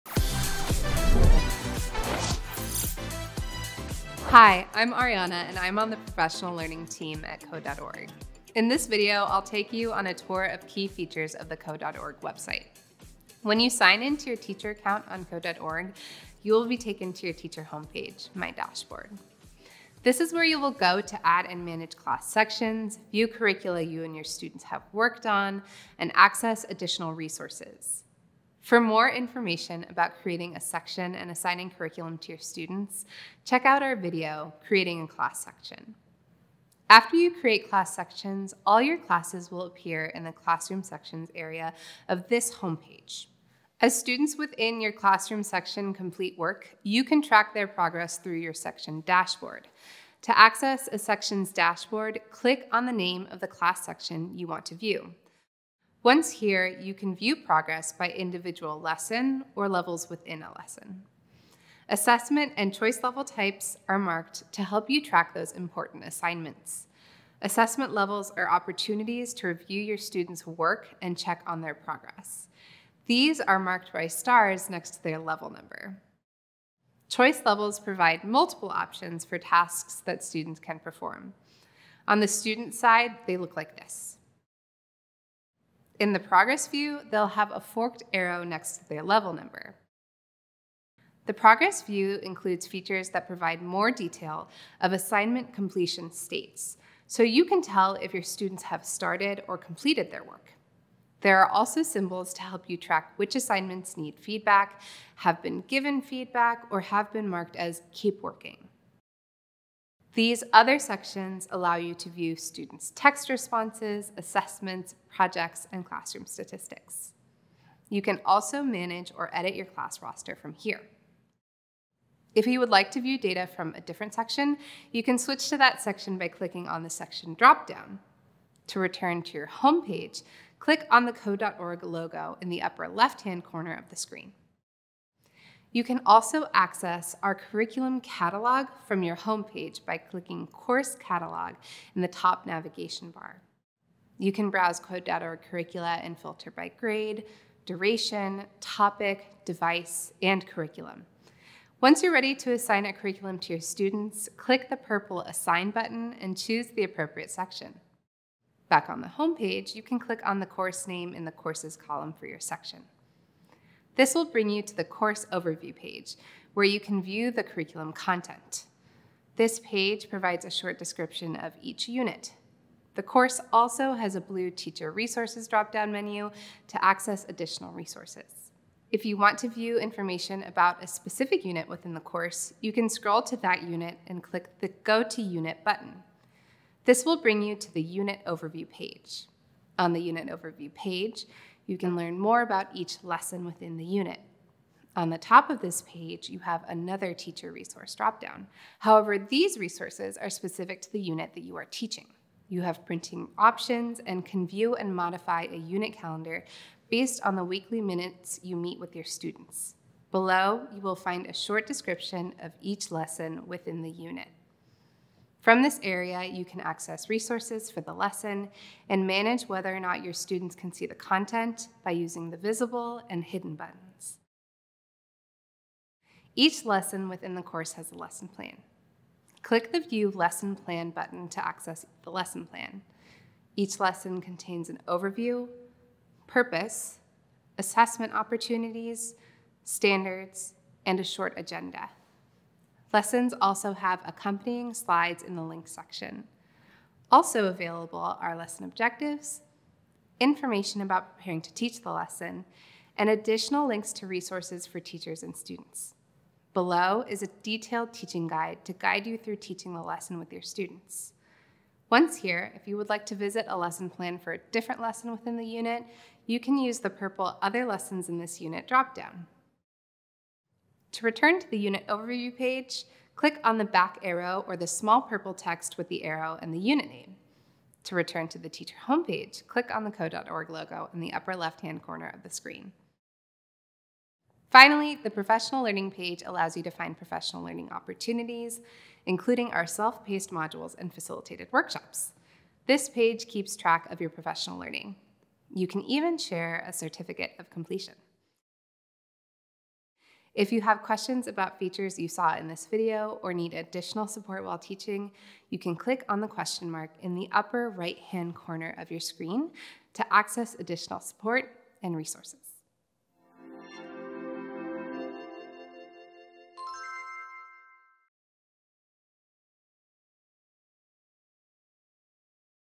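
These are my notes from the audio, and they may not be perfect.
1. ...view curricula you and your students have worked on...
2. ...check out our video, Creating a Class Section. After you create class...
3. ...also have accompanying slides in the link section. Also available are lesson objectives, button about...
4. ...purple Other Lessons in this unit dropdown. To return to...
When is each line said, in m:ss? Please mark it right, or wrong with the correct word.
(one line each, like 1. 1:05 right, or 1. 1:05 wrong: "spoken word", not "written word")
1. 0:23 right
2. 0:33 right
3. 4:03 wrong: "information", not "button"
4. 4:26 right.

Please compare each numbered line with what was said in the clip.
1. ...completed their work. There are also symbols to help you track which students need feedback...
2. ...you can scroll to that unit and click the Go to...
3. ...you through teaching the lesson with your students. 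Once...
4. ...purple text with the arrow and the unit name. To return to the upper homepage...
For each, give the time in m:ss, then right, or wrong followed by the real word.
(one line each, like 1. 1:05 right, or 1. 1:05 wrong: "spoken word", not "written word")
1. 1:39 wrong: "assignments", not "students"
2. 3:02 right
3. 4:19 right
4. 4:35 wrong: "teacher", not "upper".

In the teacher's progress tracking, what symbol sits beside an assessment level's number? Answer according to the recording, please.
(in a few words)
Stars.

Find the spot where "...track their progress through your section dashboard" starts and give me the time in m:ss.
0:47.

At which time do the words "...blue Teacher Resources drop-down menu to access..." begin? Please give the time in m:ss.
2:54.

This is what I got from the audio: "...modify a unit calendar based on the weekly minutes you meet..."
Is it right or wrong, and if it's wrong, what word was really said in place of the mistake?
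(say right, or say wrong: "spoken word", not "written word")
right.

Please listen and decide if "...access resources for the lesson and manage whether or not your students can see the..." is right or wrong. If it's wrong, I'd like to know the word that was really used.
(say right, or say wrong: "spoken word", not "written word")
right.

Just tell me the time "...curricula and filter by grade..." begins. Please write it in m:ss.
2:25.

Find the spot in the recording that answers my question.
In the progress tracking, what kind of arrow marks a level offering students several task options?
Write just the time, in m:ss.
1:27.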